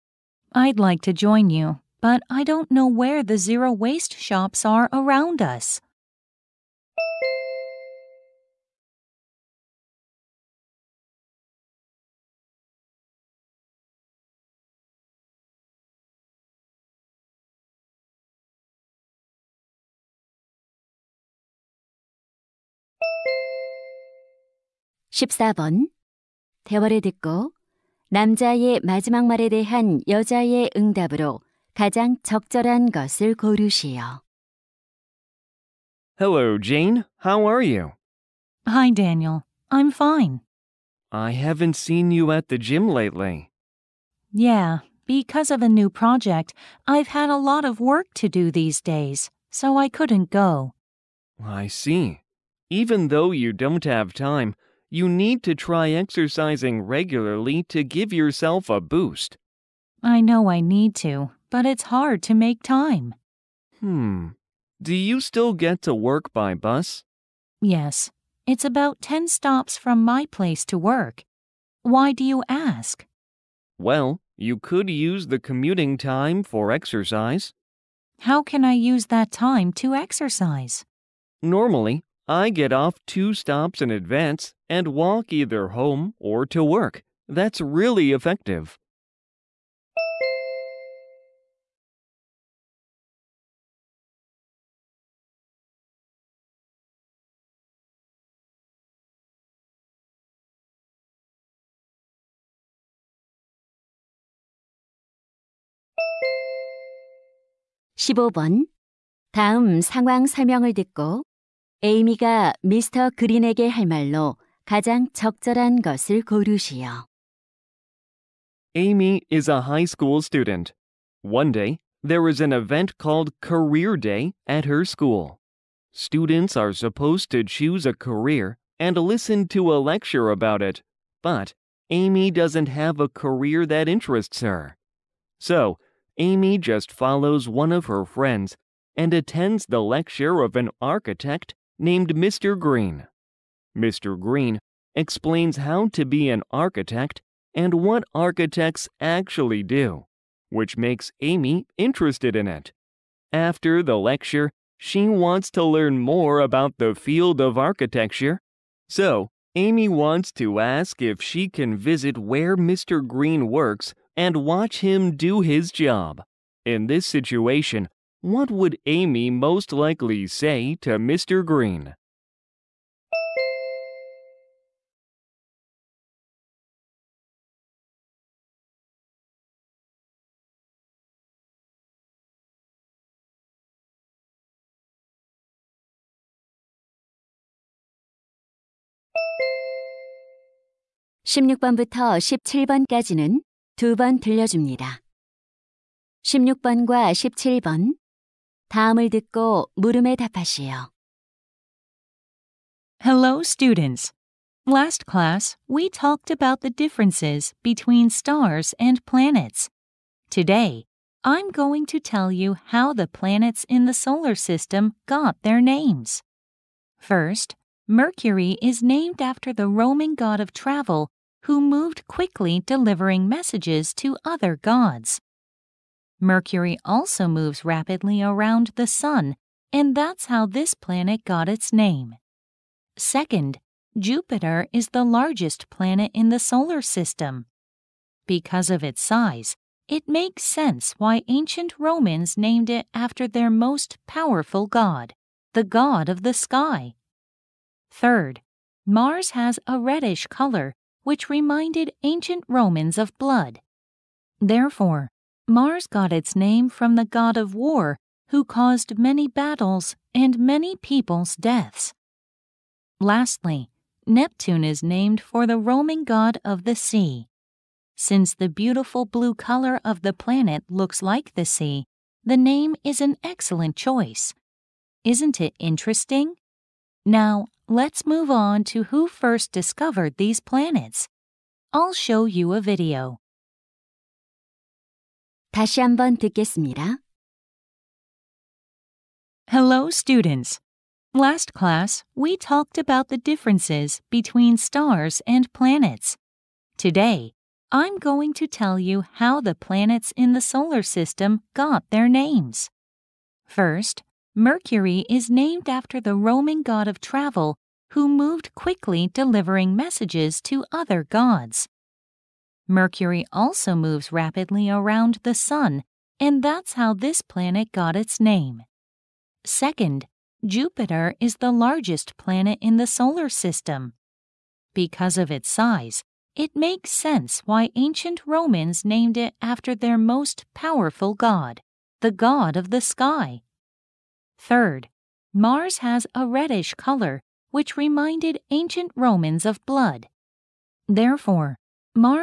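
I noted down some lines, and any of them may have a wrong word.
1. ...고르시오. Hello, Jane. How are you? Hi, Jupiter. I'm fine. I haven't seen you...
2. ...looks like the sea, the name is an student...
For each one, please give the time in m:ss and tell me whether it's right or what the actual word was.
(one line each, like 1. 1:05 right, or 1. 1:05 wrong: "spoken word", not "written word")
1. 0:33 wrong: "Daniel", not "Jupiter"
2. 4:30 wrong: "excellent", not "student".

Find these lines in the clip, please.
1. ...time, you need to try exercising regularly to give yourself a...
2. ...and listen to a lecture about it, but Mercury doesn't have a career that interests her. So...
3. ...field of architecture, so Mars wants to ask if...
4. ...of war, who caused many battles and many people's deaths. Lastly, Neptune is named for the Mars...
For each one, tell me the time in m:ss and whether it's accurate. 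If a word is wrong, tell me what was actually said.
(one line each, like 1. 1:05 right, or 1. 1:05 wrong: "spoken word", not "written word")
1. 0:54 right
2. 2:08 wrong: "Amy", not "Mercury"
3. 2:36 wrong: "Amy", not "Mars"
4. 4:17 wrong: "Roman", not "Mars".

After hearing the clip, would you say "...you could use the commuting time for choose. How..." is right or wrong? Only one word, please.
wrong.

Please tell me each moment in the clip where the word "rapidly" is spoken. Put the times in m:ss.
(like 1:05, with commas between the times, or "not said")
3:47, 5:14.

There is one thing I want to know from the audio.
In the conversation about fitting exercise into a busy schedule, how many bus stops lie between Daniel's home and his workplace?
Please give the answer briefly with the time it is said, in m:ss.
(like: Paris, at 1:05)
10, at 1:09.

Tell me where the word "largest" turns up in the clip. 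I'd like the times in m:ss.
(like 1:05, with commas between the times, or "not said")
3:55, 5:21.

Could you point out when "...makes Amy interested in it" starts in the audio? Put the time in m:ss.
2:30.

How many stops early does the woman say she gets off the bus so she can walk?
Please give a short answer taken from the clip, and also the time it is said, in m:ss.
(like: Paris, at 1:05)
2, at 1:23.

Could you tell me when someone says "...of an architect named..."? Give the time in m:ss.
2:20.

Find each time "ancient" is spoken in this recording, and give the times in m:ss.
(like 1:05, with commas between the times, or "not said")
4:01, 4:12, 5:27, 5:38.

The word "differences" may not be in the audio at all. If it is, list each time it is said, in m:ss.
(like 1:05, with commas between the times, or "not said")
3:26, 4:53.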